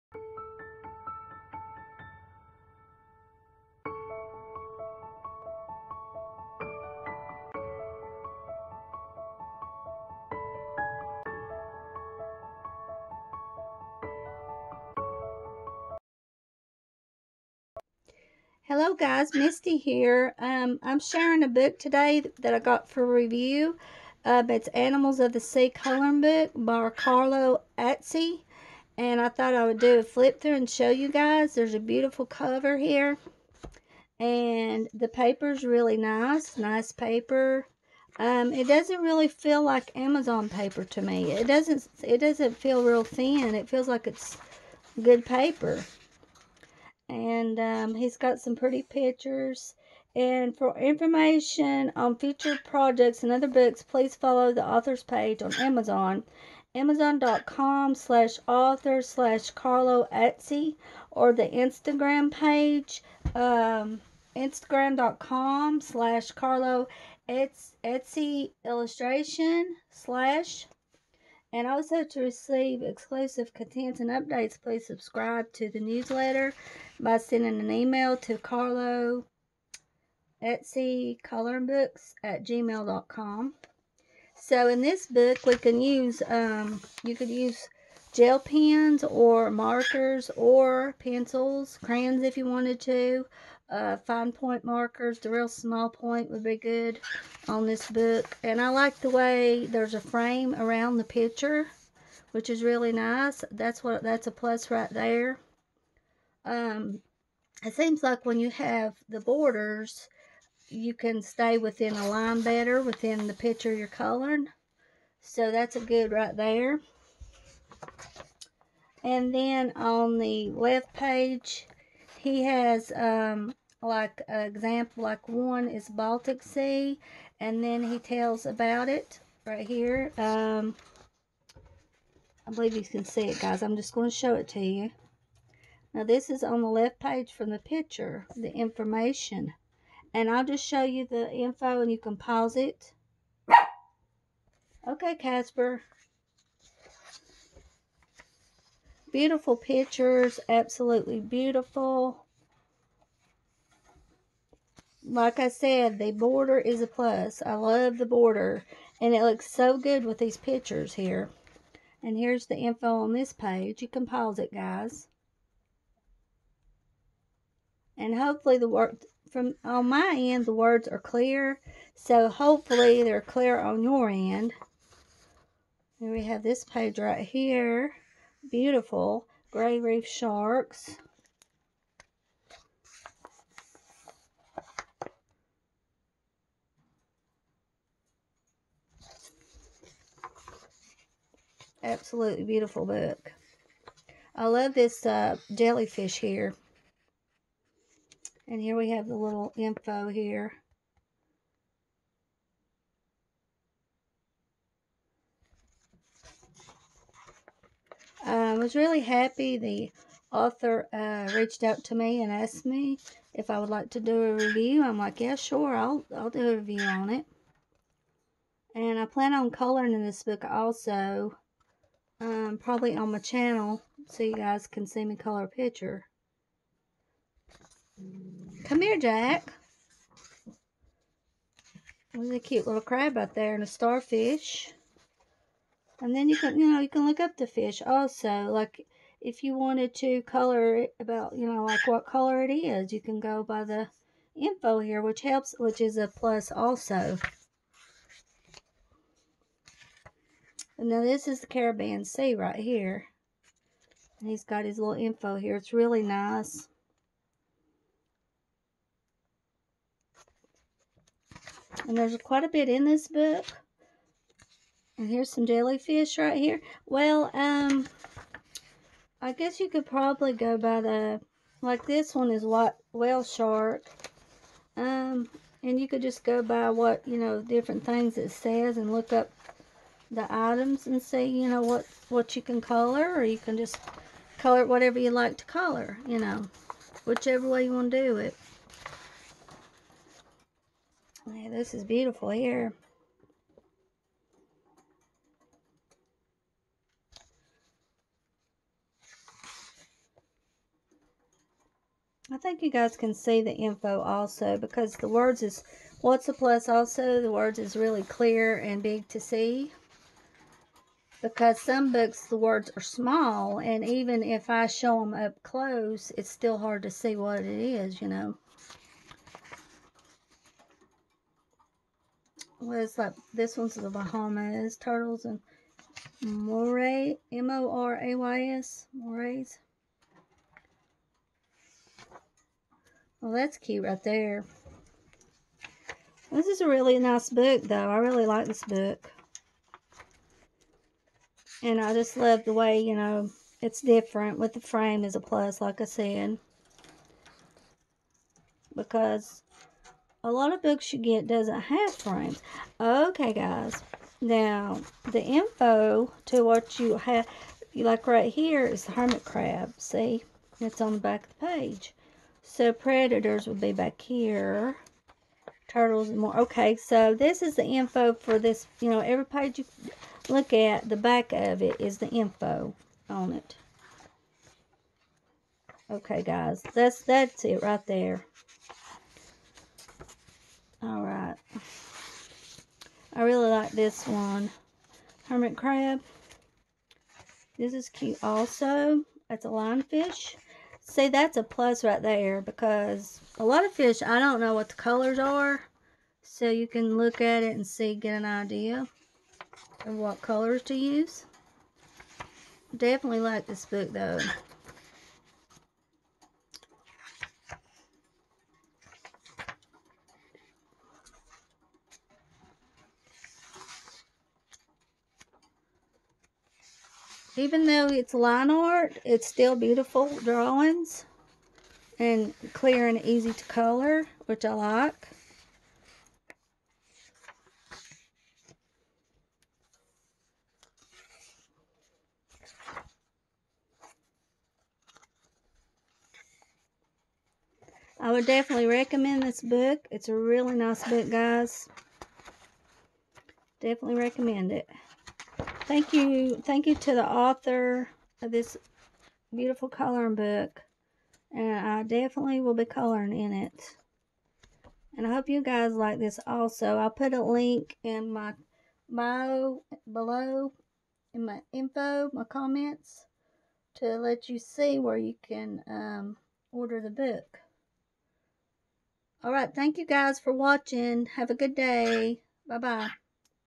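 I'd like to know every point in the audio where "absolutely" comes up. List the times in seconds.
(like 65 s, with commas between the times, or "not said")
150 s, 191 s.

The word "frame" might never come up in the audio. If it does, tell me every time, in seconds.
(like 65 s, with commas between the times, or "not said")
100 s, 344 s, 351 s.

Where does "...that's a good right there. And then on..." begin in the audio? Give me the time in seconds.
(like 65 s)
115 s.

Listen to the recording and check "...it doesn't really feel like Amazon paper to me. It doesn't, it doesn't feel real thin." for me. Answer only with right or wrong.
right.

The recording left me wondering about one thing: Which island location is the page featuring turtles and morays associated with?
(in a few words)
Bahamas.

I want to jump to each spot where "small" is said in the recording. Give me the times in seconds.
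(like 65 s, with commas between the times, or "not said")
95 s, 312 s.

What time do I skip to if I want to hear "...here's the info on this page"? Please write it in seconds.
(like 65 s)
162 s.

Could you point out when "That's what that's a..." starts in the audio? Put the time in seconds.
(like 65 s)
103 s.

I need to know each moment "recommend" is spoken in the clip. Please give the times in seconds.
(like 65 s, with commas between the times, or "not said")
438 s, 444 s.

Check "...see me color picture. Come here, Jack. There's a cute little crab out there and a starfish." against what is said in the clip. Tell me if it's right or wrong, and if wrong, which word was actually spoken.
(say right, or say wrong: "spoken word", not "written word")
right.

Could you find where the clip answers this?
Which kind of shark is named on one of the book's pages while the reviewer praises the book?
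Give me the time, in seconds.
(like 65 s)
179 s.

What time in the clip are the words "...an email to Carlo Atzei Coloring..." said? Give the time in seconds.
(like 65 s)
77 s.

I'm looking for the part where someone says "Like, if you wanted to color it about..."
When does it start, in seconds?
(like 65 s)
238 s.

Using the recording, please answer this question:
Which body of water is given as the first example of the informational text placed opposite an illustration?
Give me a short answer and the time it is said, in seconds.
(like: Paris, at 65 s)
Baltic Sea, at 125 s.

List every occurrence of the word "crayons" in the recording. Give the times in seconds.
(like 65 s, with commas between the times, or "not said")
91 s.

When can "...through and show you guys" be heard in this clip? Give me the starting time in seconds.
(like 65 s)
30 s.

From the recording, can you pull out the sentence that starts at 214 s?
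I'm like, yeah, sure, I'll, I'll do a review on it.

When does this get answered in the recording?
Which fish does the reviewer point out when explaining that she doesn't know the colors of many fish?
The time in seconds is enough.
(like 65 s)
389 s.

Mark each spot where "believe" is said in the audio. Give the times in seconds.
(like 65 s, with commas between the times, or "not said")
132 s.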